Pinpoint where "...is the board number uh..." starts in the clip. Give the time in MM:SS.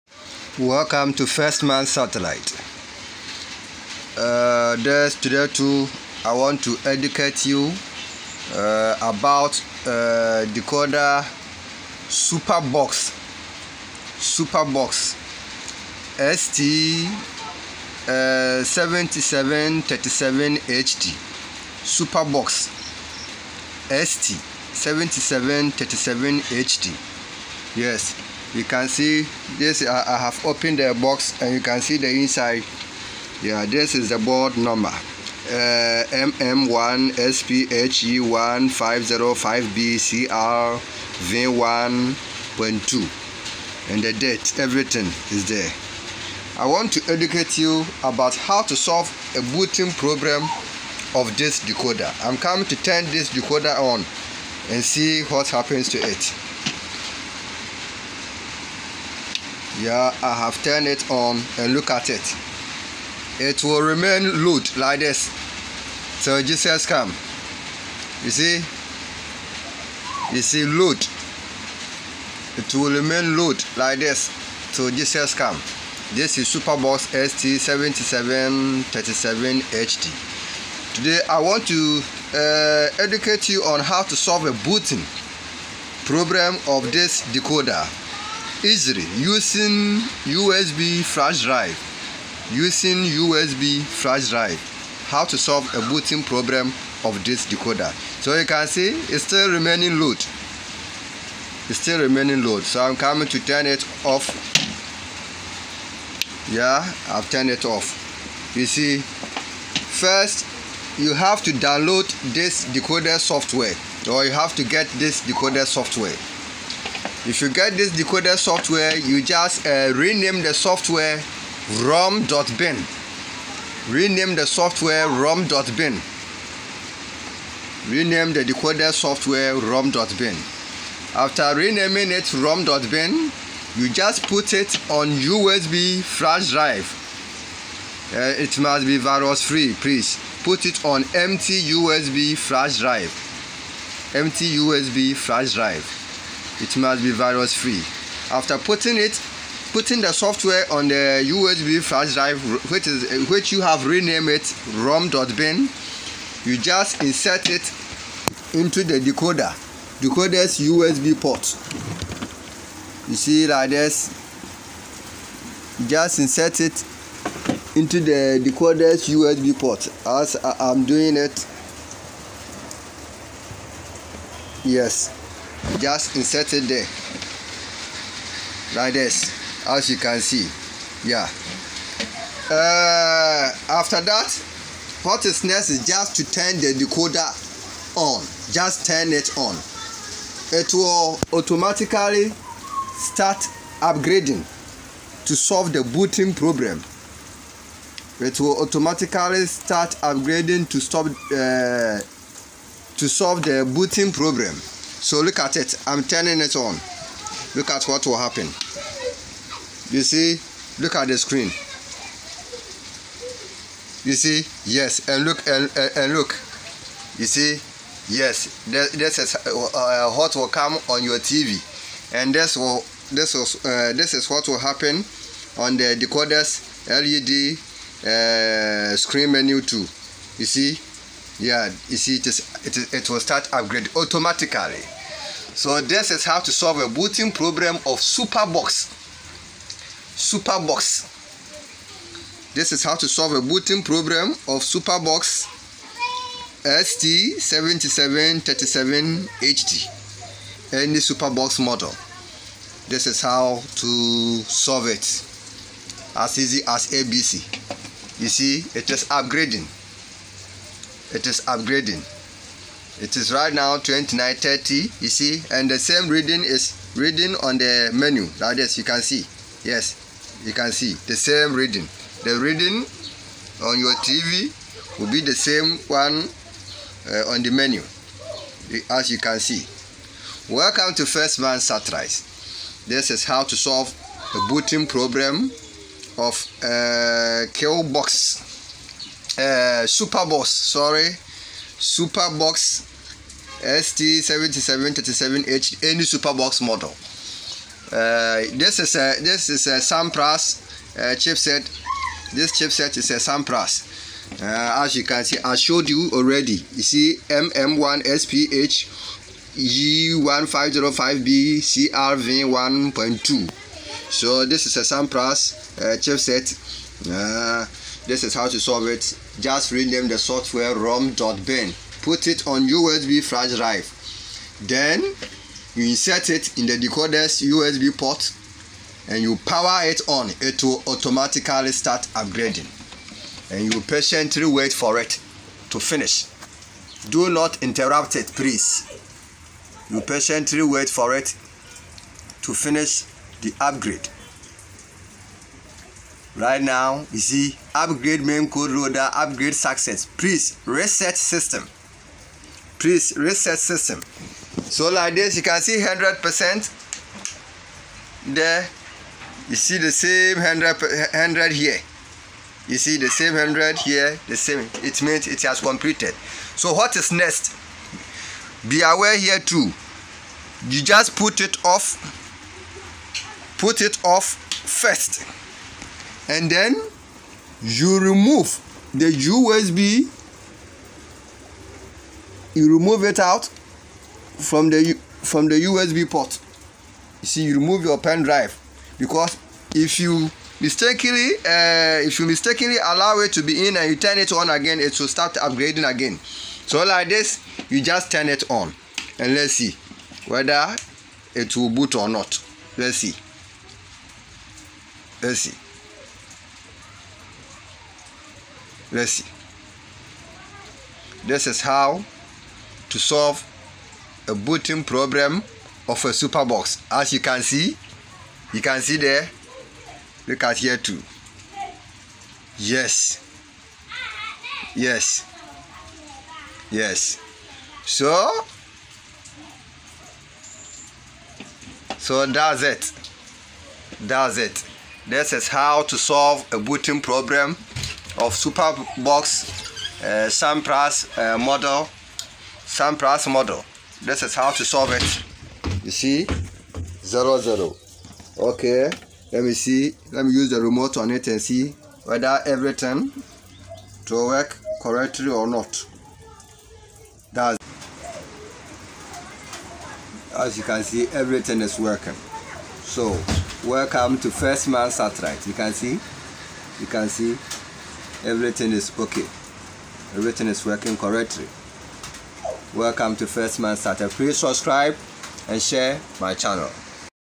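00:33.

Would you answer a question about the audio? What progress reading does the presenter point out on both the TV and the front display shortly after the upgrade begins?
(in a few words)
29.30.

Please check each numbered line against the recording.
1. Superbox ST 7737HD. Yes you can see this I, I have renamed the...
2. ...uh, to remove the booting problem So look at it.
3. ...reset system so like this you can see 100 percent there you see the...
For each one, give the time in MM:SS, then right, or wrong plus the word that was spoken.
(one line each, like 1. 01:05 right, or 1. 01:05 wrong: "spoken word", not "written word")
1. 00:21 wrong: "opened", not "renamed"
2. 03:21 wrong: "solve", not "remove"
3. 05:53 right.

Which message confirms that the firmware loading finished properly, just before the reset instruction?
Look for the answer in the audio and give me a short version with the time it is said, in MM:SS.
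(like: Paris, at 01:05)
upgrade main code loader upgrade success, at 05:47.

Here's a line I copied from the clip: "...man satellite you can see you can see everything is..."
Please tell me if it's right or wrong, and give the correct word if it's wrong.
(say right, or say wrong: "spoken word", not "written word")
right.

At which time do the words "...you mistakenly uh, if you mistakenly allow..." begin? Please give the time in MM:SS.
06:29.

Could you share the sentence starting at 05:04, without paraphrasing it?
Uh, as you can see, I showed you already.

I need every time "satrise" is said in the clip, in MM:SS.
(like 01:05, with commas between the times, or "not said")
04:41.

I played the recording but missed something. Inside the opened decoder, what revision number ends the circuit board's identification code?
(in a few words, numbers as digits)
V1.2.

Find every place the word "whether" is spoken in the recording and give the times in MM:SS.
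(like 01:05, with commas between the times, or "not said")
06:40, 07:32.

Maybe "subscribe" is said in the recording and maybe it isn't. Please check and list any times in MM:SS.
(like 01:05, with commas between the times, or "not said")
07:54.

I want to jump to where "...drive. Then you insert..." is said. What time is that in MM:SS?
05:23.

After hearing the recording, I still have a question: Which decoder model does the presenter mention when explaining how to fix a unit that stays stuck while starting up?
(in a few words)
Superbox ST 7737HD.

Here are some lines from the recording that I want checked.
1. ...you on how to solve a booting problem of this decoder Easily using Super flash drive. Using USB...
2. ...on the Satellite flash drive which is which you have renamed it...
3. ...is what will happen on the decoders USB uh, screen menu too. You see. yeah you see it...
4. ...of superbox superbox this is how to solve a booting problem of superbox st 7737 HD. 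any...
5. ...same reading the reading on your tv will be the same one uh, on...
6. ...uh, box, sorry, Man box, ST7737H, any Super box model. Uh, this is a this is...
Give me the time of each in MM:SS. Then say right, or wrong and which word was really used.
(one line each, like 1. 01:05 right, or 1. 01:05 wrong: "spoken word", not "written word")
1. 01:23 wrong: "USB", not "Super"
2. 02:30 wrong: "USB", not "Satellite"
3. 03:44 wrong: "LED", not "USB"
4. 03:57 right
5. 04:31 right
6. 04:49 wrong: "Super", not "Man".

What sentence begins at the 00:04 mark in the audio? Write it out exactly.
Uh, this, today too, I want to educate you uh, about uh, decoder Superbox.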